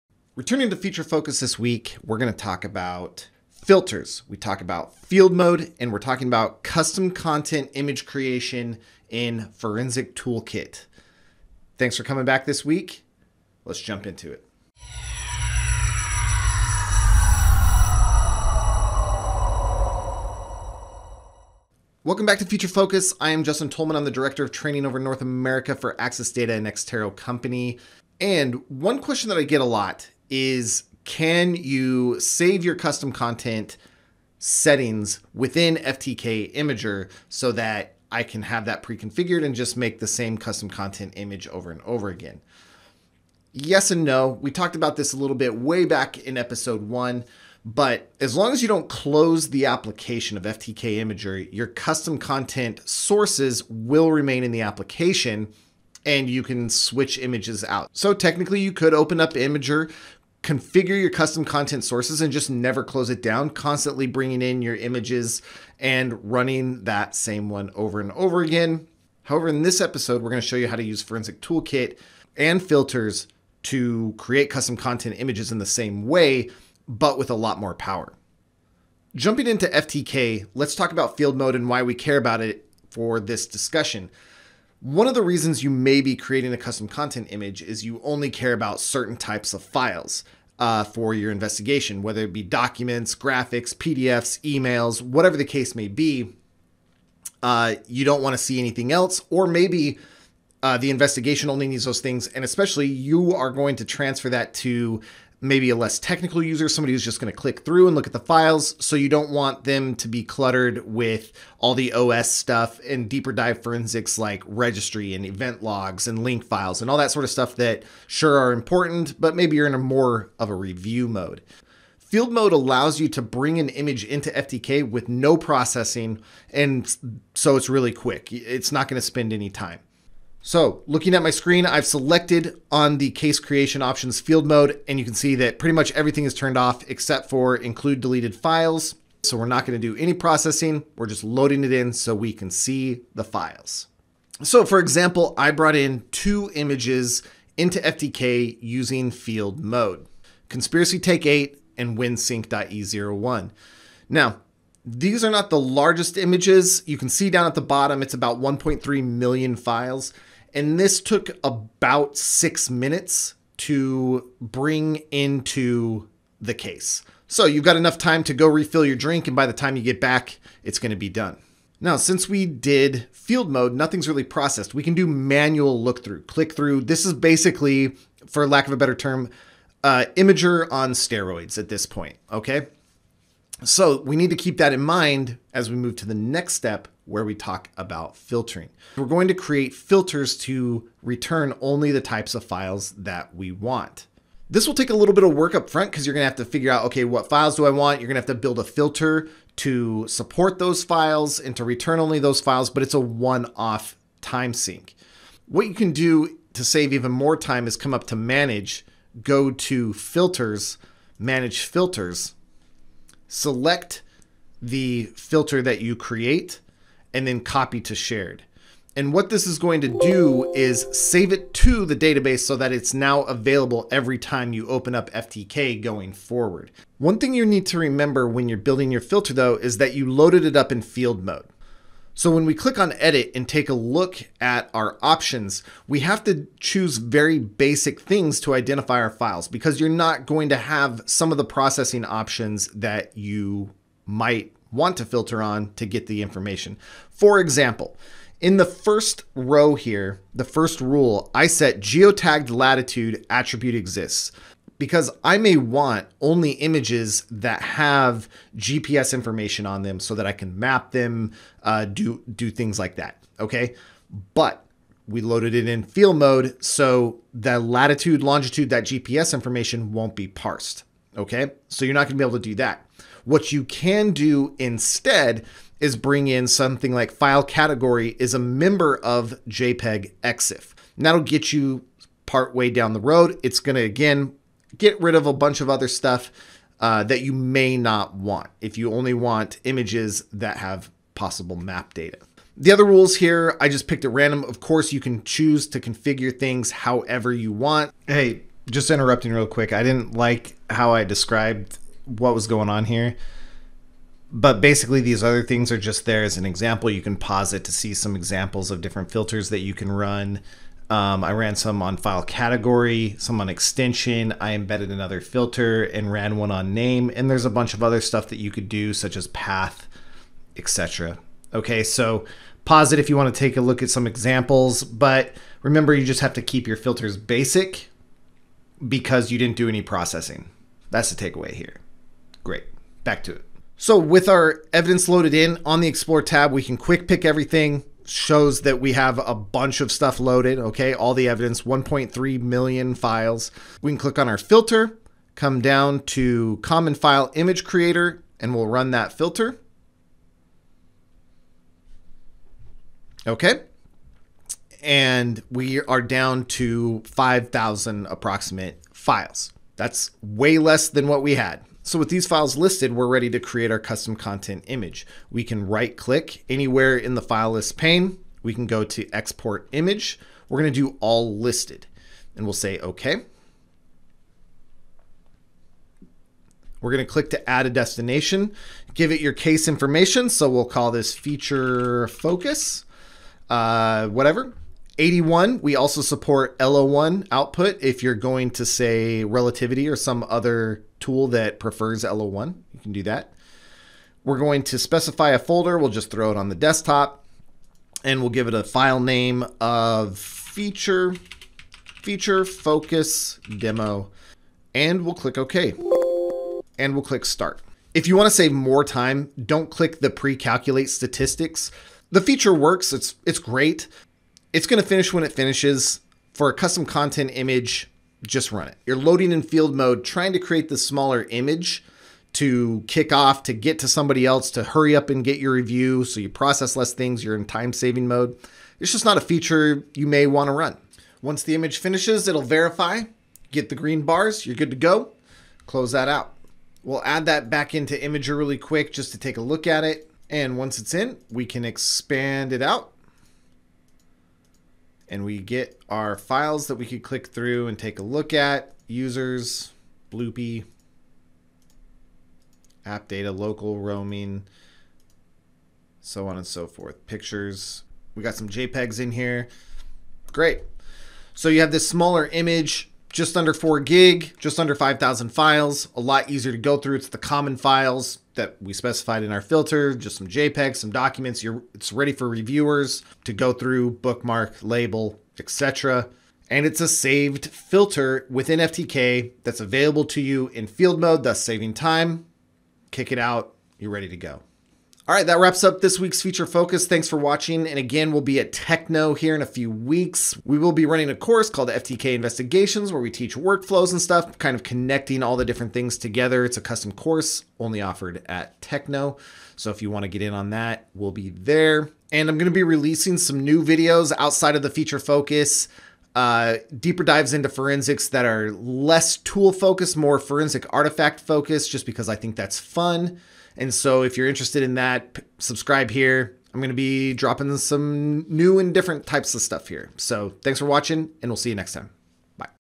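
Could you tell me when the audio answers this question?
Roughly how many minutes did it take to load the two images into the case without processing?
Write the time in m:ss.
2:42.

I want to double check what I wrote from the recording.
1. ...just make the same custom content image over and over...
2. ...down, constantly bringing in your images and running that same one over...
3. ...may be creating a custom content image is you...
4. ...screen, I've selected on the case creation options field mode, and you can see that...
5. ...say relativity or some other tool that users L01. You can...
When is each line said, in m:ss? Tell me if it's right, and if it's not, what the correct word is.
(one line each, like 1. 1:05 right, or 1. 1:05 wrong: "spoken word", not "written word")
1. 0:39 right
2. 1:03 right
3. 1:25 right
4. 2:11 right
5. 6:28 wrong: "prefers", not "users".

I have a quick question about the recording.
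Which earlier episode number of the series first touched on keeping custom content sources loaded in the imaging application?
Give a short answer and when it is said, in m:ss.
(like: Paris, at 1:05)
1, at 0:46.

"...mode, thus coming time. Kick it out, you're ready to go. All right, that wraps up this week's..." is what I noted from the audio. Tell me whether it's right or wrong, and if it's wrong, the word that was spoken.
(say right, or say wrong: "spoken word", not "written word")
wrong: "saving", not "coming".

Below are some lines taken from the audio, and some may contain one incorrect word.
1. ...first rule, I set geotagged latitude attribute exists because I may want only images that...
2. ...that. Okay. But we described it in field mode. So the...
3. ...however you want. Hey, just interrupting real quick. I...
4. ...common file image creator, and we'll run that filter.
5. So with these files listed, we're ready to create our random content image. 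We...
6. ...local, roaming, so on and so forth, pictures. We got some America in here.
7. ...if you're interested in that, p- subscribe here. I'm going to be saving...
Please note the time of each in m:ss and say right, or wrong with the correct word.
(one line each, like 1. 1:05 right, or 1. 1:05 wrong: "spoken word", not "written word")
1. 4:10 right
2. 4:22 wrong: "loaded", not "described"
3. 4:56 right
4. 5:46 right
5. 6:01 wrong: "custom", not "random"
6. 7:33 wrong: "JPEGs", not "America"
7. 8:34 wrong: "dropping", not "saving".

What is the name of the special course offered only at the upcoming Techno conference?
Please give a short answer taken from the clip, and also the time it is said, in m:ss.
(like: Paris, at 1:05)
FTK Investigations, at 8:11.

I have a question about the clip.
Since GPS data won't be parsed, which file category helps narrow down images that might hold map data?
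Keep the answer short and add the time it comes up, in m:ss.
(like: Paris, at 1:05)
JPEG EXIF, at 4:39.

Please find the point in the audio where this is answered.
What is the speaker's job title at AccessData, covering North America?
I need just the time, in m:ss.
0:24.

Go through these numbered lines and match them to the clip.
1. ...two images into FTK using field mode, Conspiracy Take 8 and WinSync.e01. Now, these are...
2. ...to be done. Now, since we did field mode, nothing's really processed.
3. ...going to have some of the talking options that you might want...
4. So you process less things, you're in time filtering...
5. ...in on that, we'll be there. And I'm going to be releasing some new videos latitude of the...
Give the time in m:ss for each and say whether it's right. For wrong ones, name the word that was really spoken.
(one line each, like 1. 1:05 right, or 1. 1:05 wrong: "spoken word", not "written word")
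1. 2:26 right
2. 2:50 right
3. 4:00 wrong: "processing", not "talking"
4. 7:06 wrong: "saving", not "filtering"
5. 8:20 wrong: "outside", not "latitude".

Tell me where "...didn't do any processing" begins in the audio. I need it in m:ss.
5:29.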